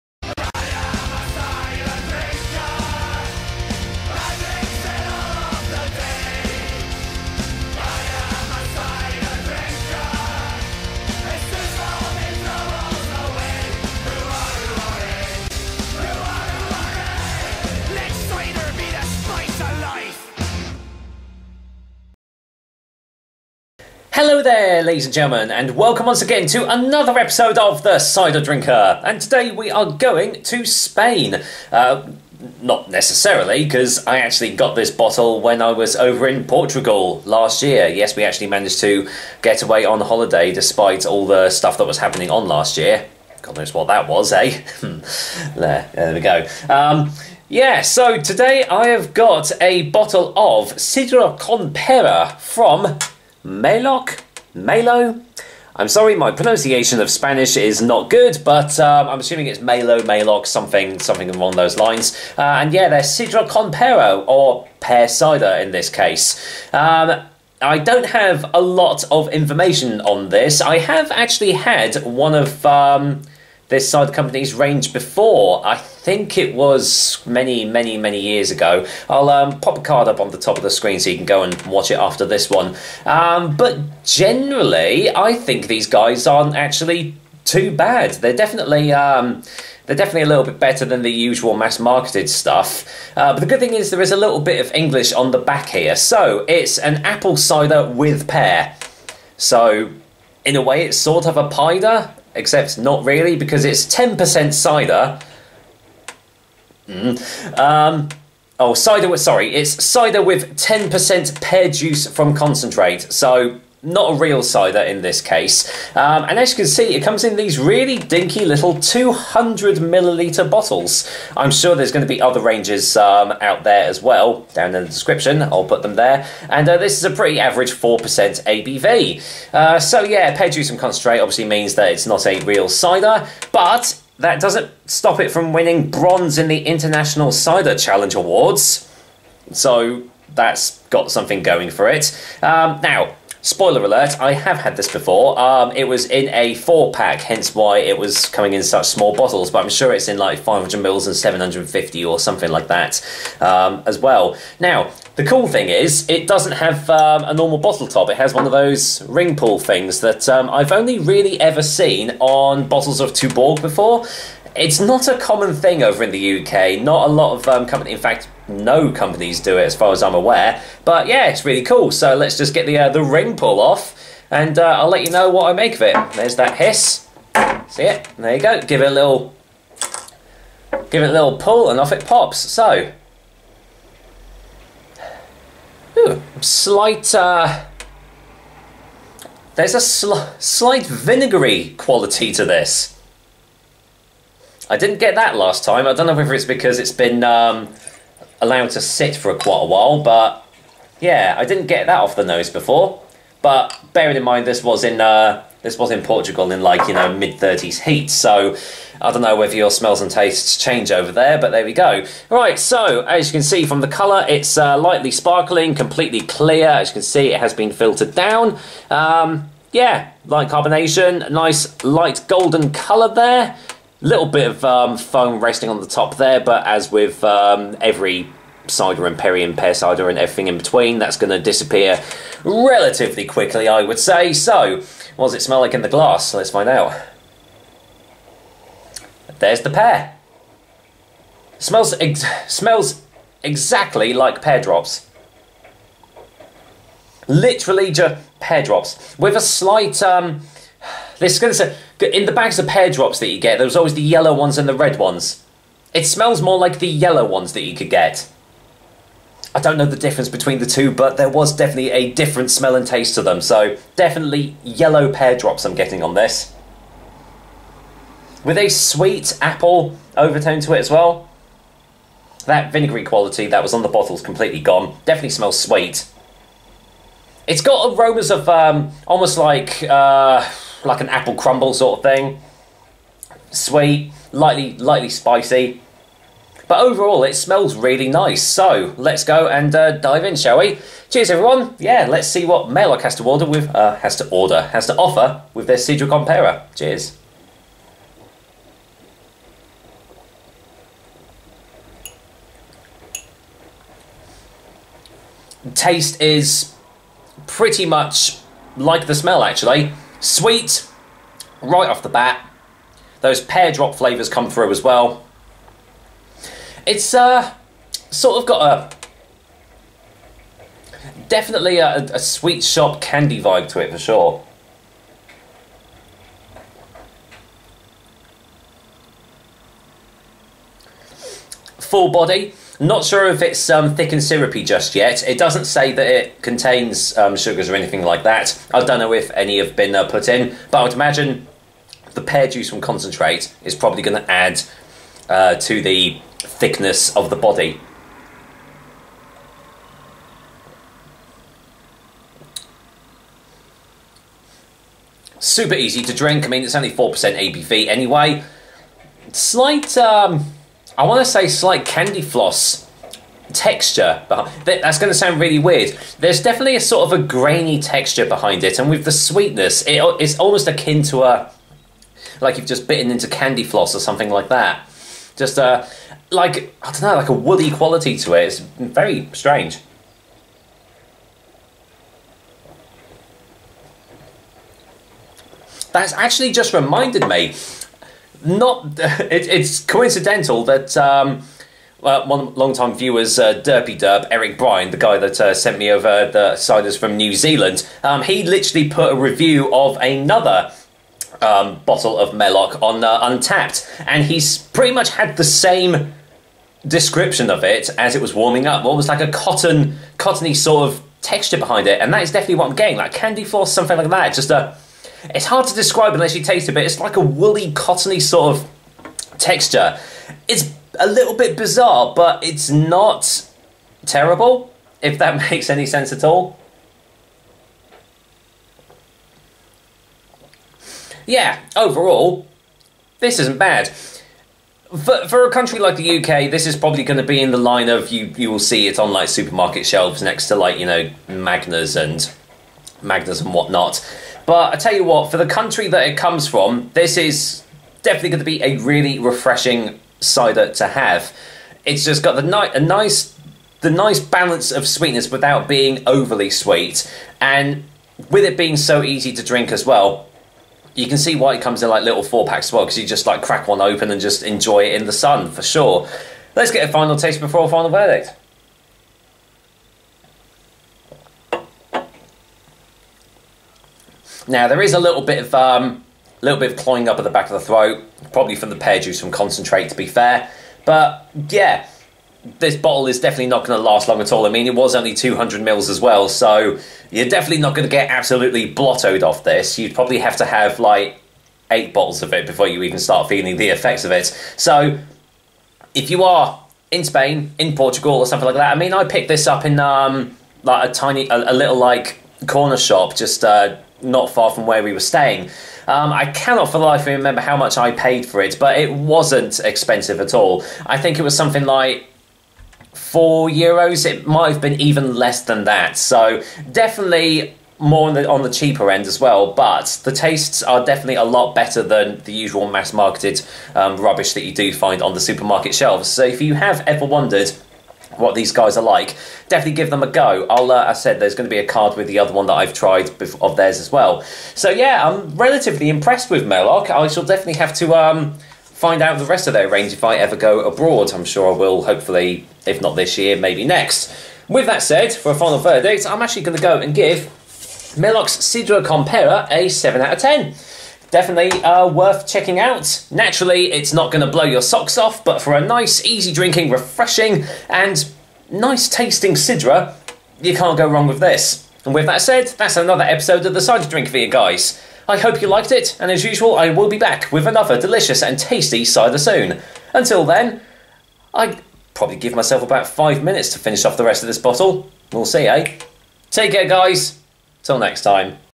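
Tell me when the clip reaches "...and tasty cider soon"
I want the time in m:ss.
9:28.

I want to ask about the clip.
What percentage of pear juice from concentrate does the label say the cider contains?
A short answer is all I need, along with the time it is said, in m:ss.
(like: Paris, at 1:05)
10%, at 1:50.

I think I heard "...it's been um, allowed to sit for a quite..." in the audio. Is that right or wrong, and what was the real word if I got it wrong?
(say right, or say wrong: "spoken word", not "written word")
right.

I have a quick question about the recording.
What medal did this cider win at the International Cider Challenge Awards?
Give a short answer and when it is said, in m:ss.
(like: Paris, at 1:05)
Bronze, at 2:15.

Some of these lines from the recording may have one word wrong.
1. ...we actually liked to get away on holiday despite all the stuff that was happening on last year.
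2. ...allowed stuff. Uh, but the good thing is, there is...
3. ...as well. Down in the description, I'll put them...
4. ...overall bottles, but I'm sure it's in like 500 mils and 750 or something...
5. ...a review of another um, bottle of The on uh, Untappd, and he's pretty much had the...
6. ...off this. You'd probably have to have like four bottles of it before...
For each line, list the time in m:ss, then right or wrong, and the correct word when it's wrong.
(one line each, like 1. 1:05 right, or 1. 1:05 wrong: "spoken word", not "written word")
1. 0:38 wrong: "managed", not "liked"
2. 1:31 wrong: "marketed", not "allowed"
3. 2:03 right
4. 2:28 wrong: "small", not "overall"
5. 6:39 wrong: "Maeloc", not "The"
6. 8:09 wrong: "eight", not "four".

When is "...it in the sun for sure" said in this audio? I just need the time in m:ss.
7:44.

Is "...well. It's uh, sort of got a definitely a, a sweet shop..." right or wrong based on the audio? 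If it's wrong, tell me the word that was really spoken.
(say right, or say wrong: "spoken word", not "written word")
right.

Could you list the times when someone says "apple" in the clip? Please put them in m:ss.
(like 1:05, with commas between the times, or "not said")
1:37, 4:29, 4:41.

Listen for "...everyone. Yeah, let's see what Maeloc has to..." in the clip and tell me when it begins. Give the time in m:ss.
4:51.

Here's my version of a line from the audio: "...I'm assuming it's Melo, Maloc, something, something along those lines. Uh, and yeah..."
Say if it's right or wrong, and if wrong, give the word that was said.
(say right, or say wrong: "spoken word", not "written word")
right.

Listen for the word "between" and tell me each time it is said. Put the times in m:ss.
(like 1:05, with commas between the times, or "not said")
3:50, 4:20.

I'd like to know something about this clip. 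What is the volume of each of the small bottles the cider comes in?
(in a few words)
200 milliliters.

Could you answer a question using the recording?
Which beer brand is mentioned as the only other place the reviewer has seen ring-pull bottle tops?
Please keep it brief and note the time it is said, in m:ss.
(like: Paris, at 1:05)
Tuborg, at 2:43.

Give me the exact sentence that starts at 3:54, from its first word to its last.
So, what does it smell like in the glass?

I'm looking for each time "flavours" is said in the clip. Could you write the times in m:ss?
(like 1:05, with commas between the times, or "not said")
5:13.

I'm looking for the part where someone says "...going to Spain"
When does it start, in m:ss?
0:29.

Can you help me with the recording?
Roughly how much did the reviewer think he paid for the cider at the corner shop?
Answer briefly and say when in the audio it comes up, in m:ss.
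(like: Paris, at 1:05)
4 euros, at 8:32.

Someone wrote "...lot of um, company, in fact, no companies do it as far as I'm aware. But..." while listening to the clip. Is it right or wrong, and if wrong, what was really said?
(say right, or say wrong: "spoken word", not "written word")
right.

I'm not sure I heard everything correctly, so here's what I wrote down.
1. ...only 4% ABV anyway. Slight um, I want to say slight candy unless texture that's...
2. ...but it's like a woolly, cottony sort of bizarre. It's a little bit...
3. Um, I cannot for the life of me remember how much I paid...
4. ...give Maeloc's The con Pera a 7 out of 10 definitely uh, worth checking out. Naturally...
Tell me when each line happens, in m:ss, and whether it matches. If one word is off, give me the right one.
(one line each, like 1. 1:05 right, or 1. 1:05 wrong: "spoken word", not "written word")
1. 5:56 wrong: "floss", not "unless"
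2. 6:56 wrong: "texture", not "bizarre"
3. 8:25 right
4. 9:06 wrong: "Sidra", not "The".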